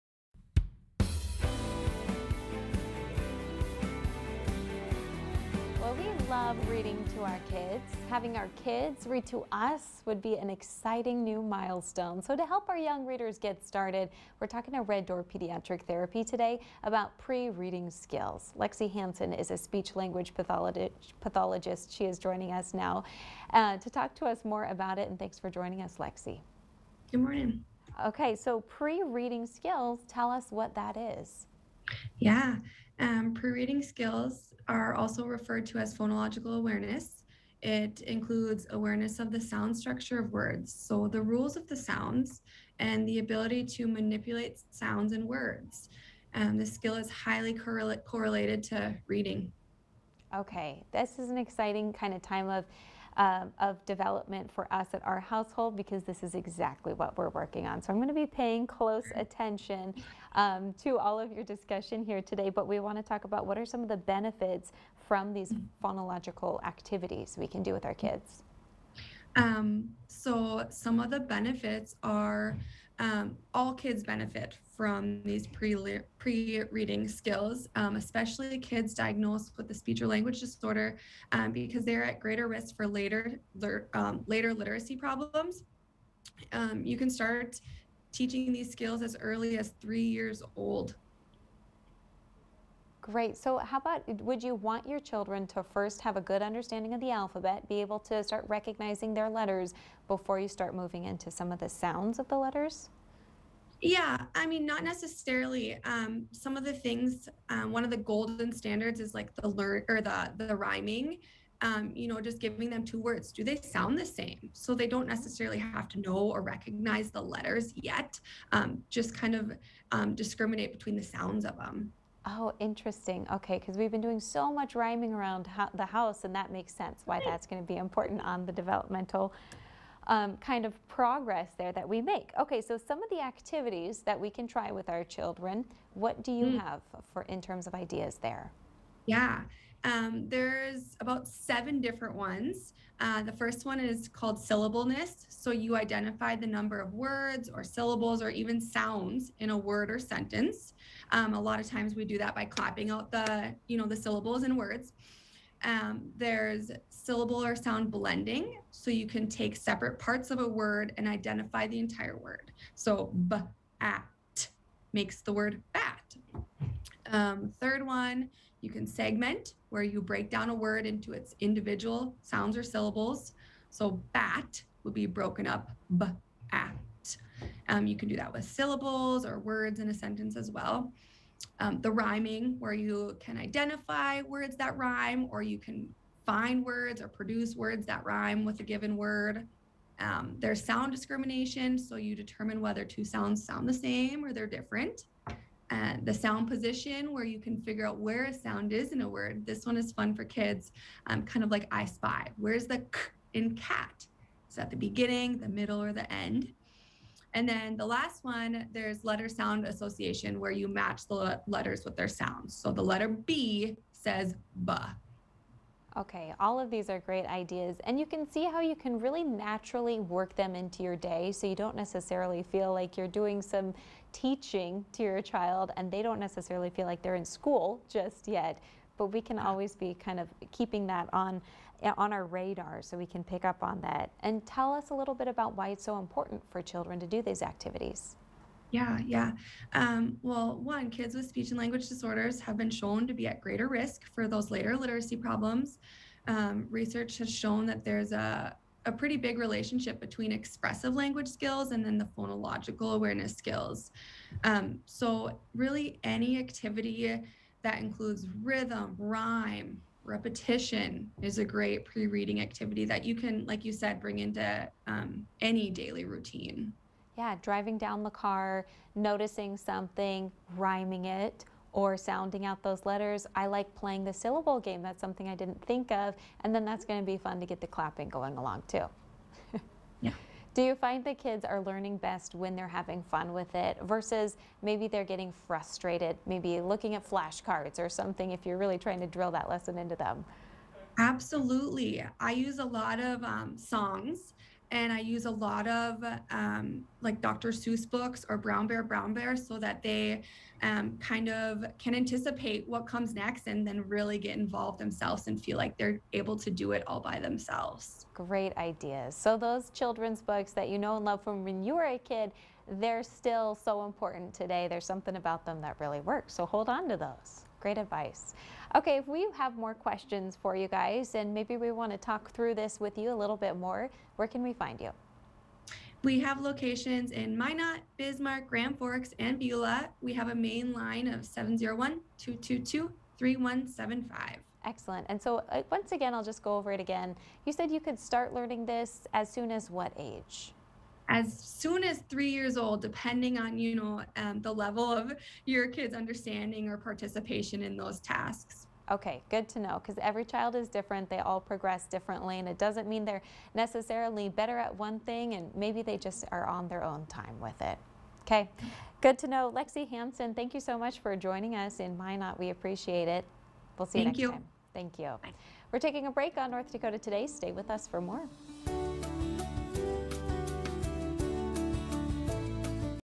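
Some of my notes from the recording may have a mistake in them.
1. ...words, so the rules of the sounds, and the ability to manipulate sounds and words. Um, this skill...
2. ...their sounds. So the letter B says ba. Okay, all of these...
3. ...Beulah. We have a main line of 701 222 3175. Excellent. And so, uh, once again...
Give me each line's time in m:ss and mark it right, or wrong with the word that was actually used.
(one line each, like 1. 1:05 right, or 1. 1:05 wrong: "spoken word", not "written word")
1. 0:40 right
2. 3:31 right
3. 5:29 right.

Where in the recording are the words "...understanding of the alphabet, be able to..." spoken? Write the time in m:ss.
1:36.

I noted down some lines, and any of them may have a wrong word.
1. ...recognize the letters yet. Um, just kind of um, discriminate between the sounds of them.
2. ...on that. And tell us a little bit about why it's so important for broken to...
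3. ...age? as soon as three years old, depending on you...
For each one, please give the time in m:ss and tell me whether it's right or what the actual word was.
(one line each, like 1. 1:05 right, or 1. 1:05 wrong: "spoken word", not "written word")
1. 1:56 right
2. 3:53 wrong: "children", not "broken"
3. 5:39 right.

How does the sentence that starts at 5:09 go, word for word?
So, those children's books that you know and love from when you were a kid, they're still so important today.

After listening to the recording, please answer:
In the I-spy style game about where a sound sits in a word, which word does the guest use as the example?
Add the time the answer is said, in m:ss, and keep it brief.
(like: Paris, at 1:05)
cat, at 3:22.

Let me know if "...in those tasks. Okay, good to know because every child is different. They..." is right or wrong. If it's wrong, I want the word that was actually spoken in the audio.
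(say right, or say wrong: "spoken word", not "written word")
right.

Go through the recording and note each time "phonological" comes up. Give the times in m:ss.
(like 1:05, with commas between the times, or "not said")
0:35, 1:05, 4:12.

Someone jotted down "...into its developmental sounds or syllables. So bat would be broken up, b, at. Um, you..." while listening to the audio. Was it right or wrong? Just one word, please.
wrong.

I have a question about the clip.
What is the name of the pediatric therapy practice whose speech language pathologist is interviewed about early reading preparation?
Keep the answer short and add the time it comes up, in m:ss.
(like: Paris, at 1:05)
Red Door Pediatric Therapy, at 0:14.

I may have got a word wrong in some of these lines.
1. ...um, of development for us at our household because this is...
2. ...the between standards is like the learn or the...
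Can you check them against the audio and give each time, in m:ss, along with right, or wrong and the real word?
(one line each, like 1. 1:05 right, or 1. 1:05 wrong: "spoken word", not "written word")
1. 0:53 right
2. 1:47 wrong: "golden", not "between".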